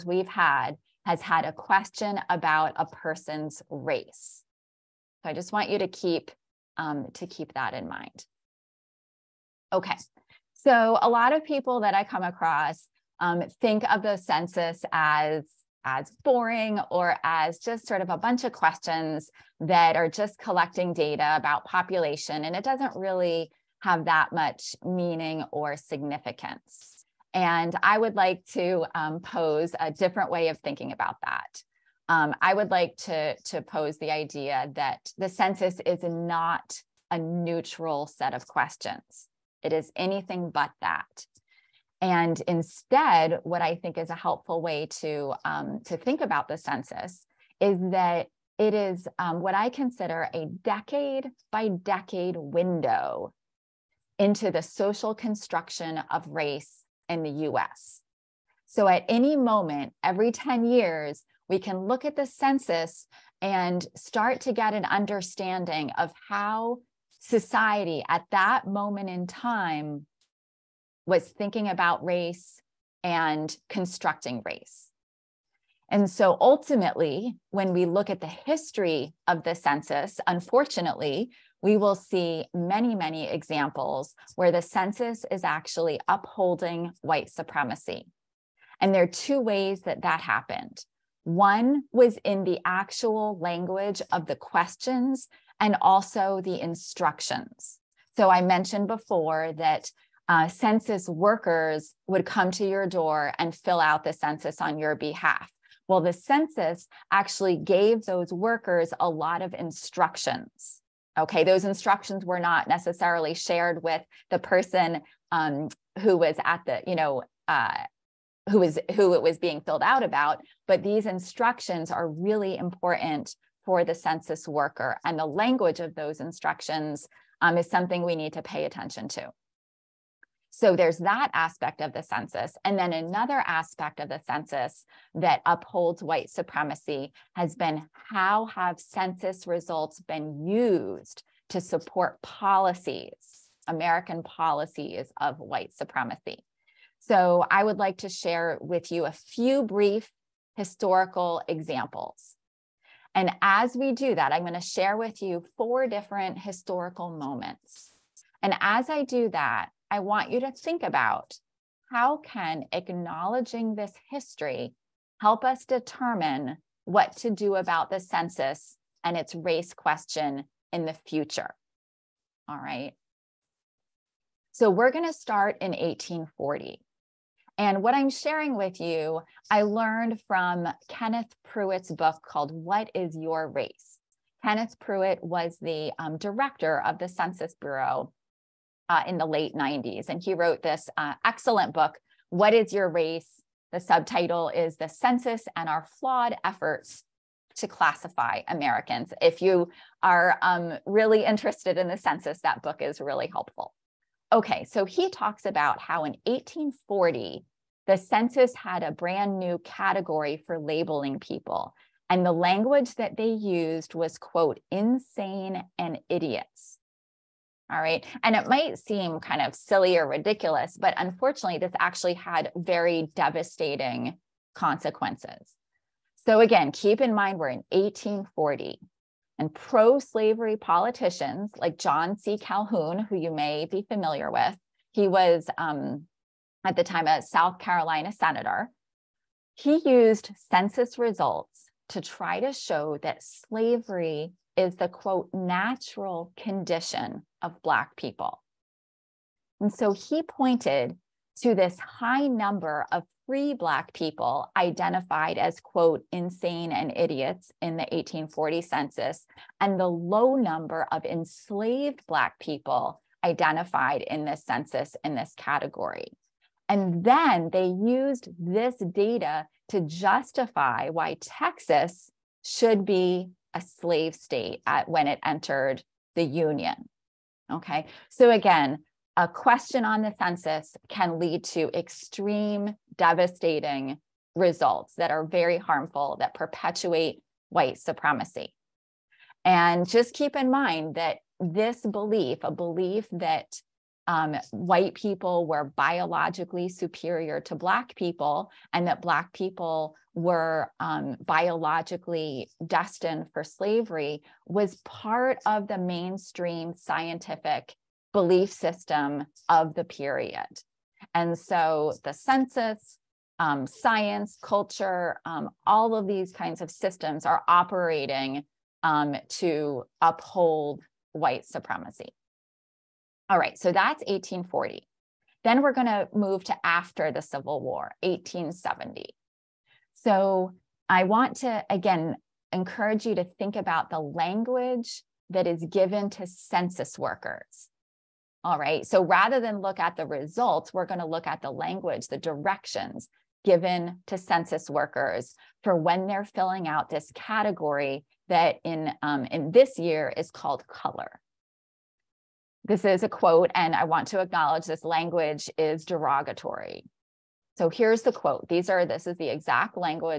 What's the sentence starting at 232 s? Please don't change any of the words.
Calhoun, who you may be familiar with, he was um, at the time a South Carolina senator.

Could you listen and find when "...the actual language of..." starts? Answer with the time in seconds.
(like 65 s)
92 s.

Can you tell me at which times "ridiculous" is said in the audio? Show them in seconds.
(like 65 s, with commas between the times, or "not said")
220 s.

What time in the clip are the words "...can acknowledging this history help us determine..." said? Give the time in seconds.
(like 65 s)
162 s.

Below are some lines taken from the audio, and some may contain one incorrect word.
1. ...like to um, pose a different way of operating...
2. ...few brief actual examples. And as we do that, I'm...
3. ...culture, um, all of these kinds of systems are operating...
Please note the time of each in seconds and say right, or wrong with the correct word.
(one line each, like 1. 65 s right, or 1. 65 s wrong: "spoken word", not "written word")
1. 28 s wrong: "thinking", not "operating"
2. 149 s wrong: "historical", not "actual"
3. 314 s right.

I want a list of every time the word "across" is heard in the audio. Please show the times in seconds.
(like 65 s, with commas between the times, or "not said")
12 s.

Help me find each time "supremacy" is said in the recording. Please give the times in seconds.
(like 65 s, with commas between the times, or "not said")
87 s, 136 s, 145 s, 287 s, 321 s.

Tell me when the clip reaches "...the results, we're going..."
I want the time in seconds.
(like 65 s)
339 s.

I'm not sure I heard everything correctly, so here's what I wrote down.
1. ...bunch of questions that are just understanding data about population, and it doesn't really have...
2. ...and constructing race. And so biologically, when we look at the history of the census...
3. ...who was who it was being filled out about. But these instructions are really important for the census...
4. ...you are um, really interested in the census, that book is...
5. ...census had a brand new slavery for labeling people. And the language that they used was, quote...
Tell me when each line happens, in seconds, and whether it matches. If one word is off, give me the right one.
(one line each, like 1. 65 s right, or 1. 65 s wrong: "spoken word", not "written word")
1. 18 s wrong: "collecting", not "understanding"
2. 73 s wrong: "ultimately", not "biologically"
3. 118 s right
4. 199 s right
5. 207 s wrong: "category", not "slavery".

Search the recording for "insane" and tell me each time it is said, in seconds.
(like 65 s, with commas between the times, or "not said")
214 s, 256 s.